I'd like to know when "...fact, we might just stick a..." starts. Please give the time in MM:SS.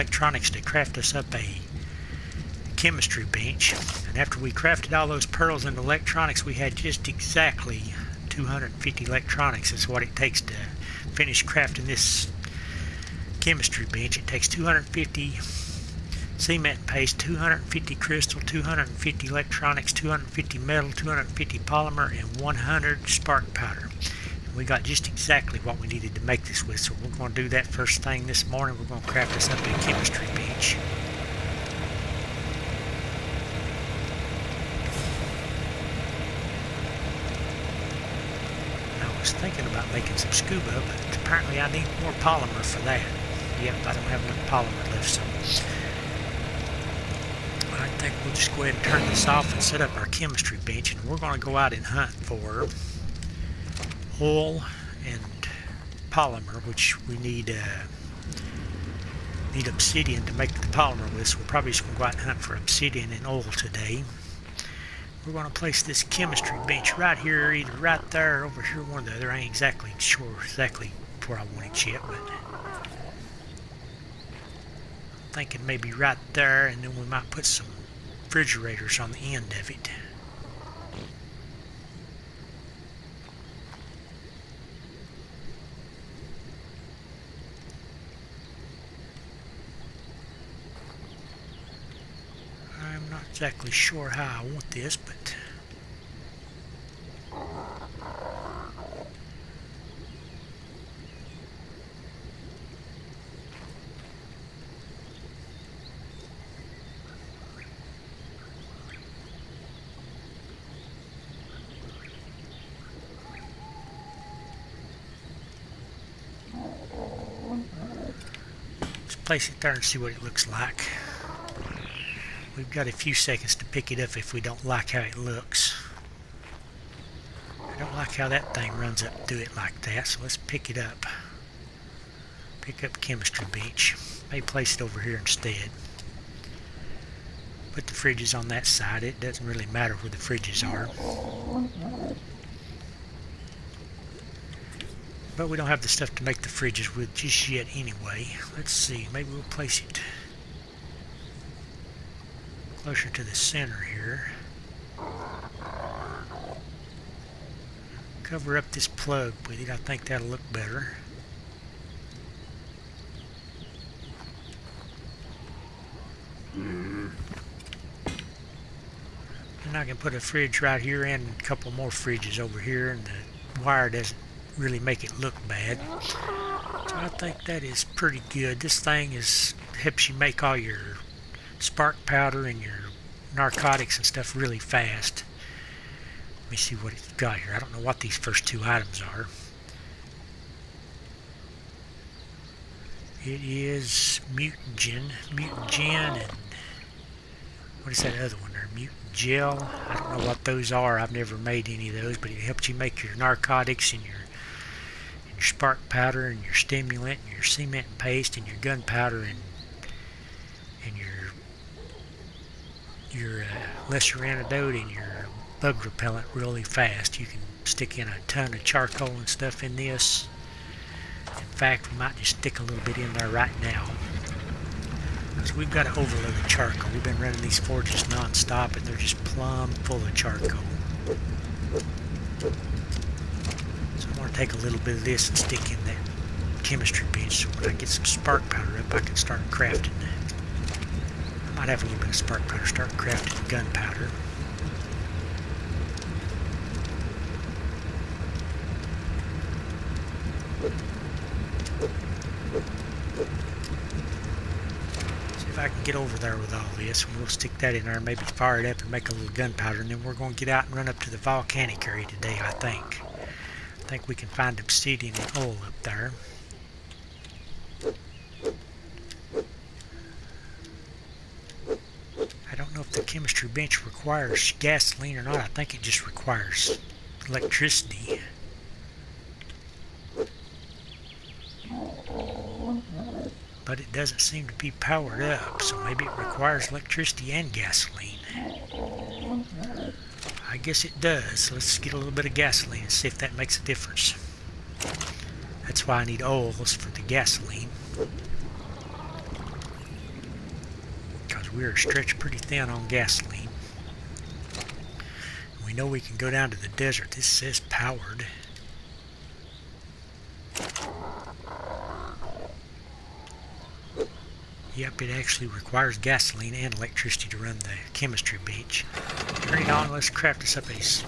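03:41.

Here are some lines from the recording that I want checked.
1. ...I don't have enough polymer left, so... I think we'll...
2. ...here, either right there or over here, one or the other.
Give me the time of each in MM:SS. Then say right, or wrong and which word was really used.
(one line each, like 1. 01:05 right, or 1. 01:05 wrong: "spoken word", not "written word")
1. 00:43 right
2. 01:07 right.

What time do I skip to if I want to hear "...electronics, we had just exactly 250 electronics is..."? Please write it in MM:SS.
00:05.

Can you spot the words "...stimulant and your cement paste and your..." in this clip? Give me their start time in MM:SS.
03:26.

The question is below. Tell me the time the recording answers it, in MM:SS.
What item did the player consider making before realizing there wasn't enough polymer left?
00:40.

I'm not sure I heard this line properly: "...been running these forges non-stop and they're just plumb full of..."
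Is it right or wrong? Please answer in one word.
right.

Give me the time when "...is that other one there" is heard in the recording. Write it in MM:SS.
03:17.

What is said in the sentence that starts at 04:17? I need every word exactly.
And we'll stick that in there, maybe fire it up and make a little gunpowder.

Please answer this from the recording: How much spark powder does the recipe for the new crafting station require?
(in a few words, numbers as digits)
100.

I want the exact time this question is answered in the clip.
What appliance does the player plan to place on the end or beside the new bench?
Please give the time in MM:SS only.
01:18.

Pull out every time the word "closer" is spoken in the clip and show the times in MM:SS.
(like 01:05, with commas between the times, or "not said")
02:32.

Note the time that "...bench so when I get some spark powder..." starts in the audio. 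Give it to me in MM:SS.
03:57.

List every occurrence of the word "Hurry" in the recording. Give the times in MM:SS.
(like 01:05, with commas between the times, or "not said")
05:19.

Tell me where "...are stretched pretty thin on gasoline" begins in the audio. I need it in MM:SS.
05:01.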